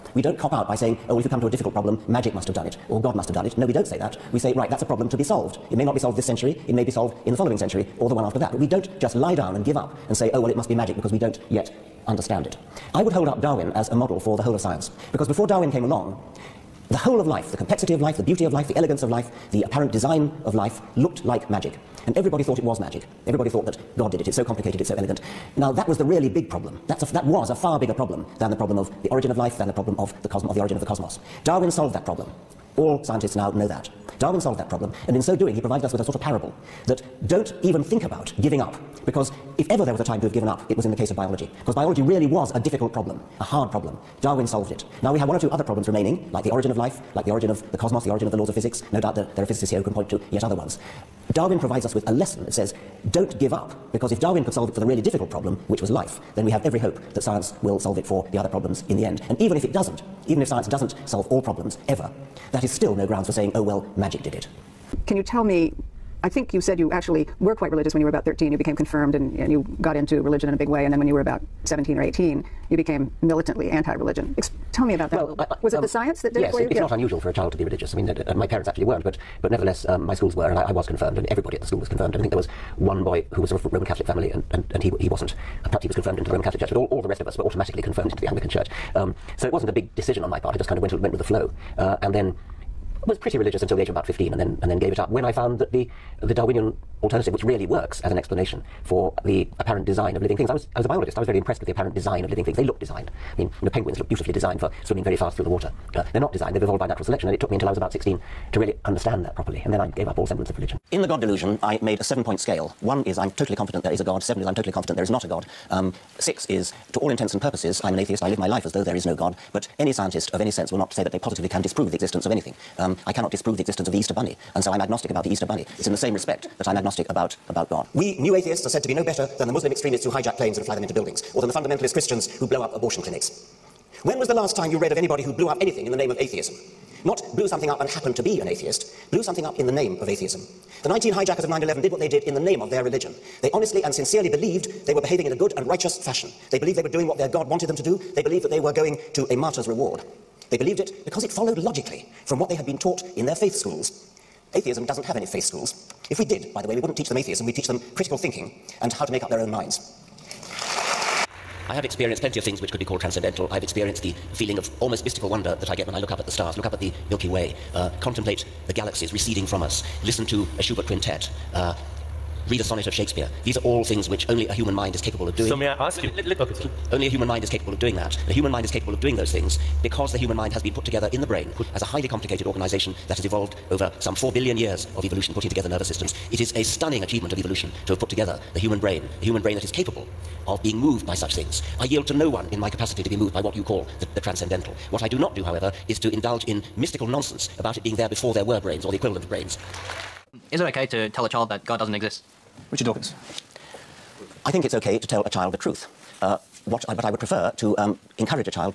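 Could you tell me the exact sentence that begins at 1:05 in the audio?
Can you tell me I think you said you actually were quite religious when you were about 13.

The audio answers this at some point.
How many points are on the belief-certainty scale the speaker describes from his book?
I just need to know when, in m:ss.
1:52.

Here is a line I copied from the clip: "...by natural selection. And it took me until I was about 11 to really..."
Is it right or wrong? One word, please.
wrong.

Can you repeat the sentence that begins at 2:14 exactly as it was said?
When was the last time you read of anybody who blew up anything in the name of atheism?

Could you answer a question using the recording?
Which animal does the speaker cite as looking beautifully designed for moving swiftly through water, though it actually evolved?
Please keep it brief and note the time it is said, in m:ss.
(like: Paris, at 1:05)
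Penguins, at 1:43.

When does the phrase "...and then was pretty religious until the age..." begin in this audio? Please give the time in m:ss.
1:32.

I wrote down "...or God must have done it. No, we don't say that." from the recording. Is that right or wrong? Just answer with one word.
right.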